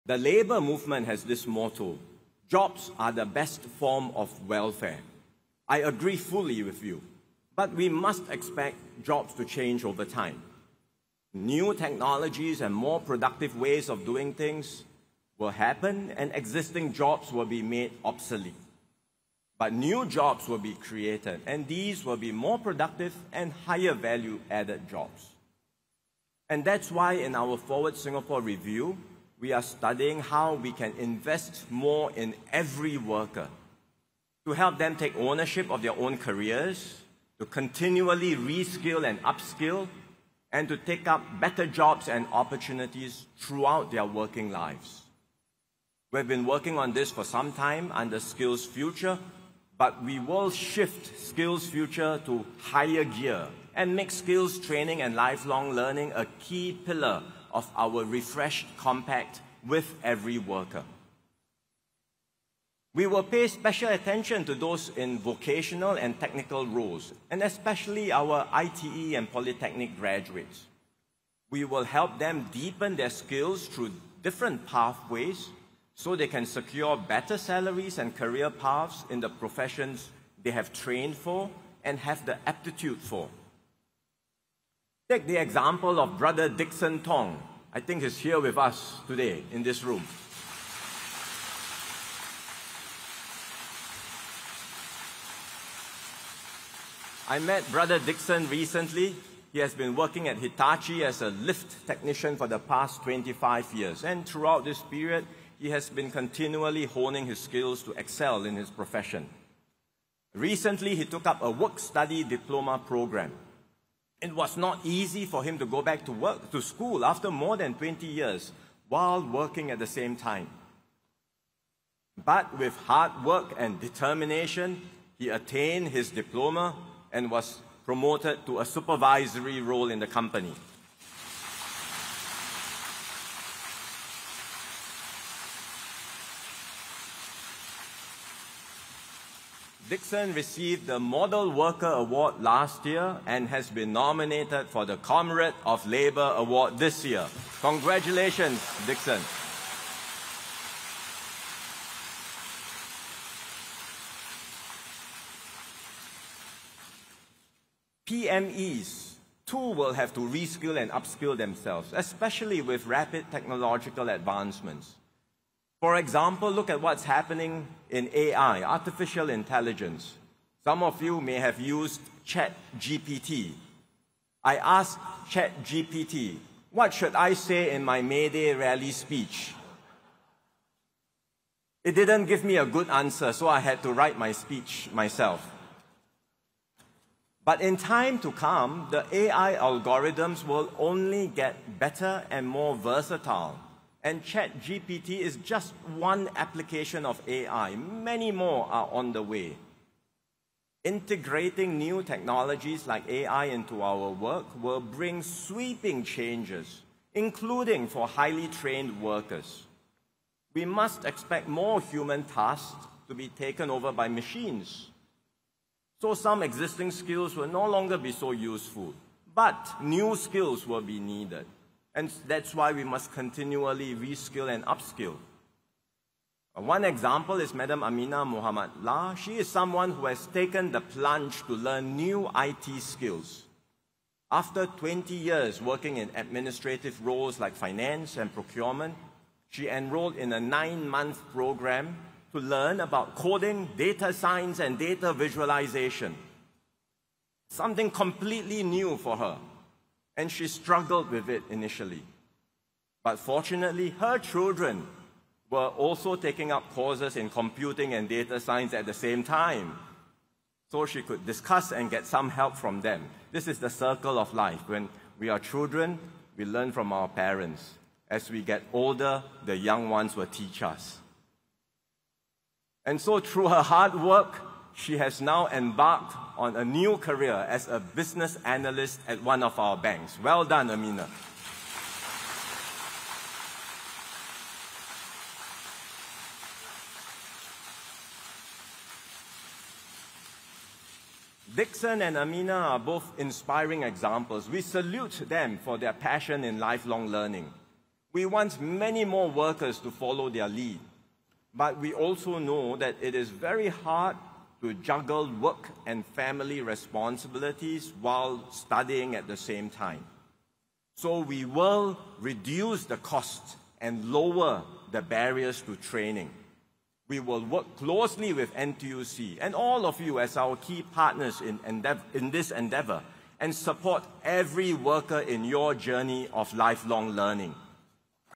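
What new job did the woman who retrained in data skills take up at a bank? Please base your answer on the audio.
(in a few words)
business analyst.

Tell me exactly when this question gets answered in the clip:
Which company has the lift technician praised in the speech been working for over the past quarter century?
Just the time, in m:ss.
1:40.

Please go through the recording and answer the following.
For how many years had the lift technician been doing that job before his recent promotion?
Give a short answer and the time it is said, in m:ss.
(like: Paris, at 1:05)
25, at 1:43.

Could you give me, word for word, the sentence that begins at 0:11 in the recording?
New technologies and more productive ways of doing things will happen, and existing jobs will be made obsolete.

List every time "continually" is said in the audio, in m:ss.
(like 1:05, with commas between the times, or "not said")
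0:37, 1:46, 3:43.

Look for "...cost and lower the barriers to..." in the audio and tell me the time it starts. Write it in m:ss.
5:12.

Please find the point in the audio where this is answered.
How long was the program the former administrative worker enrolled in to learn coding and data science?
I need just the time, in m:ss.
4:00.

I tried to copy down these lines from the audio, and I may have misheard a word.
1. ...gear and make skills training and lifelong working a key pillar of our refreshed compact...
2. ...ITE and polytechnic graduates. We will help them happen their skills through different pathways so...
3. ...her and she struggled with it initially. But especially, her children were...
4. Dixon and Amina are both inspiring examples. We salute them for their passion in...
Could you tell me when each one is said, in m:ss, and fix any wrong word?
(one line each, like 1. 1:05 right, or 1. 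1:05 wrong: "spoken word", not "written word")
1. 0:53 wrong: "learning", not "working"
2. 1:08 wrong: "deepen", not "happen"
3. 4:09 wrong: "fortunately", not "especially"
4. 4:51 right.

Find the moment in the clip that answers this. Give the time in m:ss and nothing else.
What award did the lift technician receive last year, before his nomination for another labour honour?
2:21.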